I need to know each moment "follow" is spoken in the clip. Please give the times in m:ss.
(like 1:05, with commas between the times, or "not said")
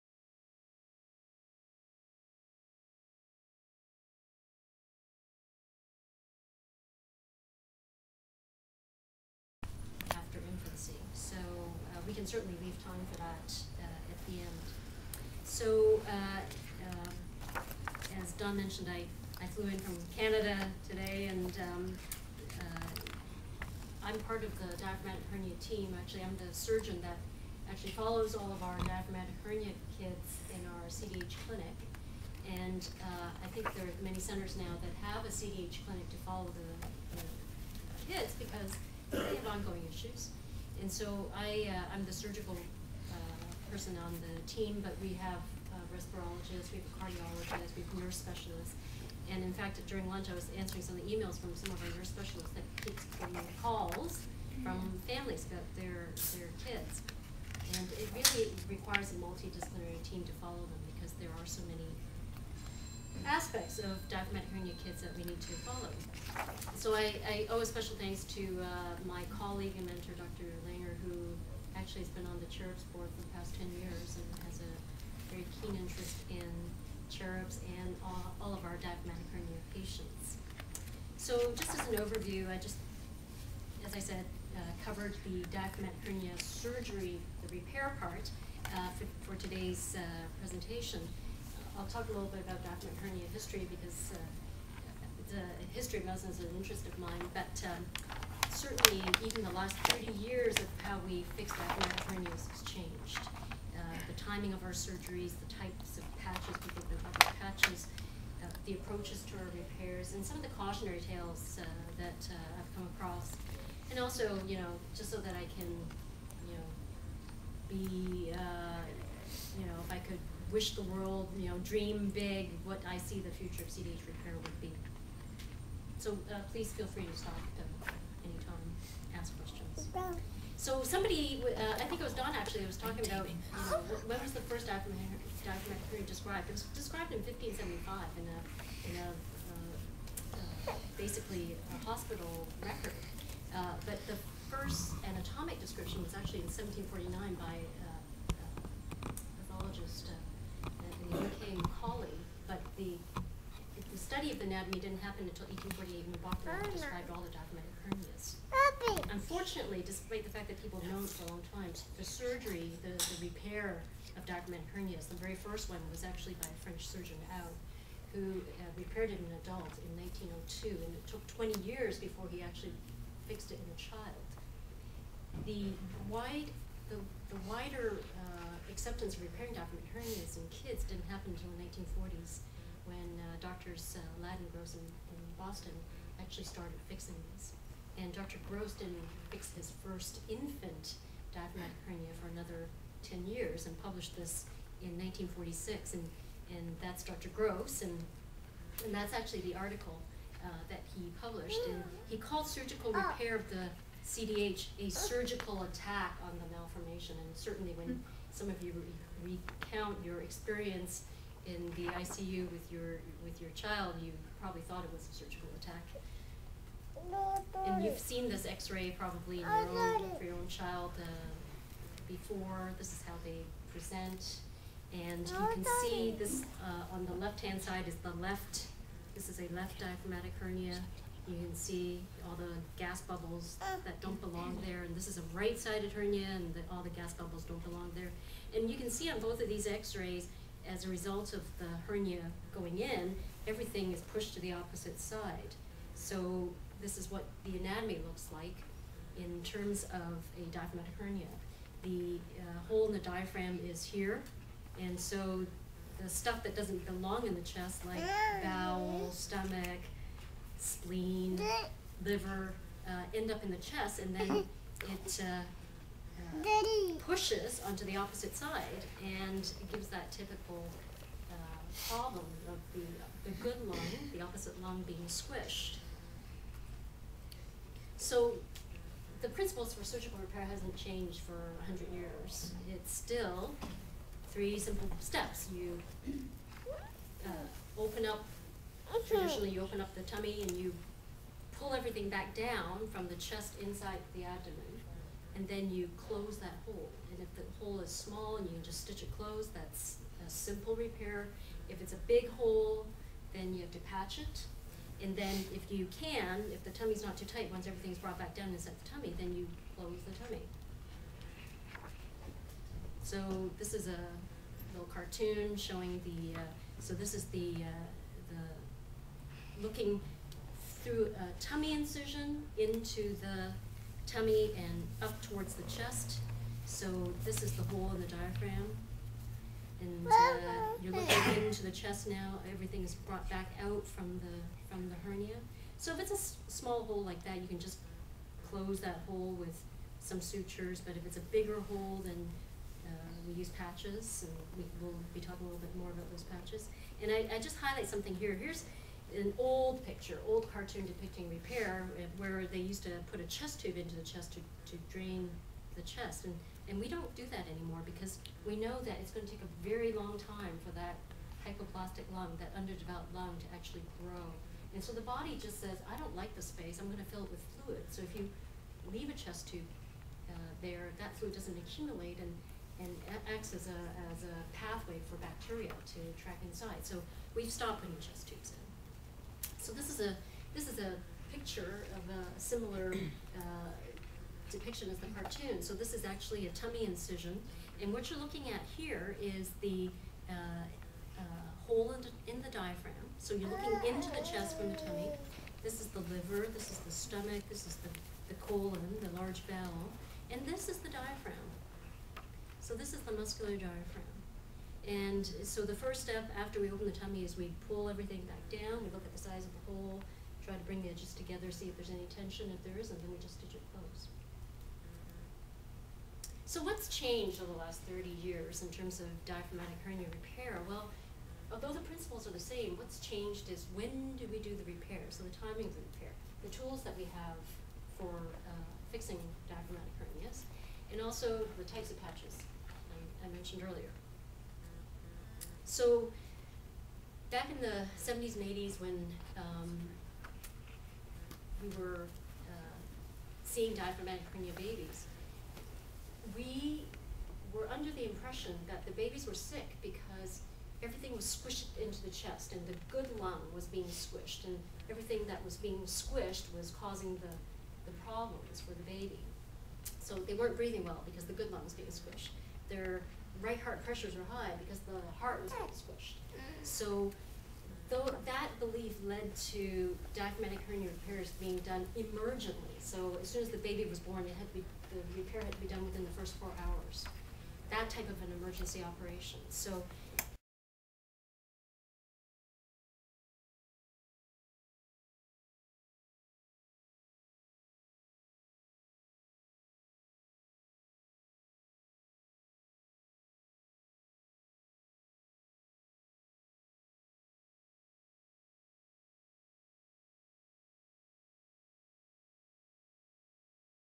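0:27, 0:36, 1:00, 1:05.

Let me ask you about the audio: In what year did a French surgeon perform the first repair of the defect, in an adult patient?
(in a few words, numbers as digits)
1902.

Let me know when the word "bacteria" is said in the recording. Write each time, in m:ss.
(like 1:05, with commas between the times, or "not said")
6:15.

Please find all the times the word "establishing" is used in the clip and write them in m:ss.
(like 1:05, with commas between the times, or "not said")
not said.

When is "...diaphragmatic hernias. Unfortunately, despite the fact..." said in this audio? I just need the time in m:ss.
2:37.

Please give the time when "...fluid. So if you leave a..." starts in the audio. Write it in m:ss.
6:07.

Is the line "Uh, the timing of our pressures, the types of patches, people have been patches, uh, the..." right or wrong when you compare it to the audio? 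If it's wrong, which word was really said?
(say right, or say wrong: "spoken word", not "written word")
wrong: "surgeries", not "pressures".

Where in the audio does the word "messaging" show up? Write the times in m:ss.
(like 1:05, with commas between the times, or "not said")
not said.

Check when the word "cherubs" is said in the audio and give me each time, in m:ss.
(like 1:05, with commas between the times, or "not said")
1:12, 1:17.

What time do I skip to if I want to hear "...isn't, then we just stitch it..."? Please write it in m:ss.
6:52.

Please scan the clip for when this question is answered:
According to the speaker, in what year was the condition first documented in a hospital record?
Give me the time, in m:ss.
2:17.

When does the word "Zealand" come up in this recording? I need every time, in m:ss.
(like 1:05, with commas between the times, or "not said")
not said.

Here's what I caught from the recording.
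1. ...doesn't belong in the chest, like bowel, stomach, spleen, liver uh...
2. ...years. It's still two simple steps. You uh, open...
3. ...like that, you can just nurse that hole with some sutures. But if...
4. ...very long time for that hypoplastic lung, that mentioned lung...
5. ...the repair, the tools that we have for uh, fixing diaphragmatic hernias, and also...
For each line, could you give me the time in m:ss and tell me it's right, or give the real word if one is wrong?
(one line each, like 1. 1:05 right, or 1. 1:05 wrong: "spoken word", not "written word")
1. 4:16 right
2. 4:41 wrong: "three", not "two"
3. 5:37 wrong: "close", not "nurse"
4. 5:59 wrong: "underdeveloped", not "mentioned"
5. 7:05 right.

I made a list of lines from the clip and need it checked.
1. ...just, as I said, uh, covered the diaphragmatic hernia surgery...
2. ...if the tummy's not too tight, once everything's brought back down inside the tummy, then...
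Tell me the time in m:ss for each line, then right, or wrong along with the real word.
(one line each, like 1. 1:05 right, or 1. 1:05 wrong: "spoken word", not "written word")
1. 1:22 right
2. 5:06 right.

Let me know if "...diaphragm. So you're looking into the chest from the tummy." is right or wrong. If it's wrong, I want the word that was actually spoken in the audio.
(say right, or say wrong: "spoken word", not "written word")
right.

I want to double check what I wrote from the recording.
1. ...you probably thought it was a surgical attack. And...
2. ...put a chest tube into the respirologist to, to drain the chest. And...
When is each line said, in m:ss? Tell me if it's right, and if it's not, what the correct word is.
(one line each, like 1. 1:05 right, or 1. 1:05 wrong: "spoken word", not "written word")
1. 3:34 right
2. 5:53 wrong: "chest", not "respirologist".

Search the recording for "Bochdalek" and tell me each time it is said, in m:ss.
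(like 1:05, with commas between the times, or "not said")
2:36.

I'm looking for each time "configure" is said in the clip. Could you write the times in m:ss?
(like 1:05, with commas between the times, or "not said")
not said.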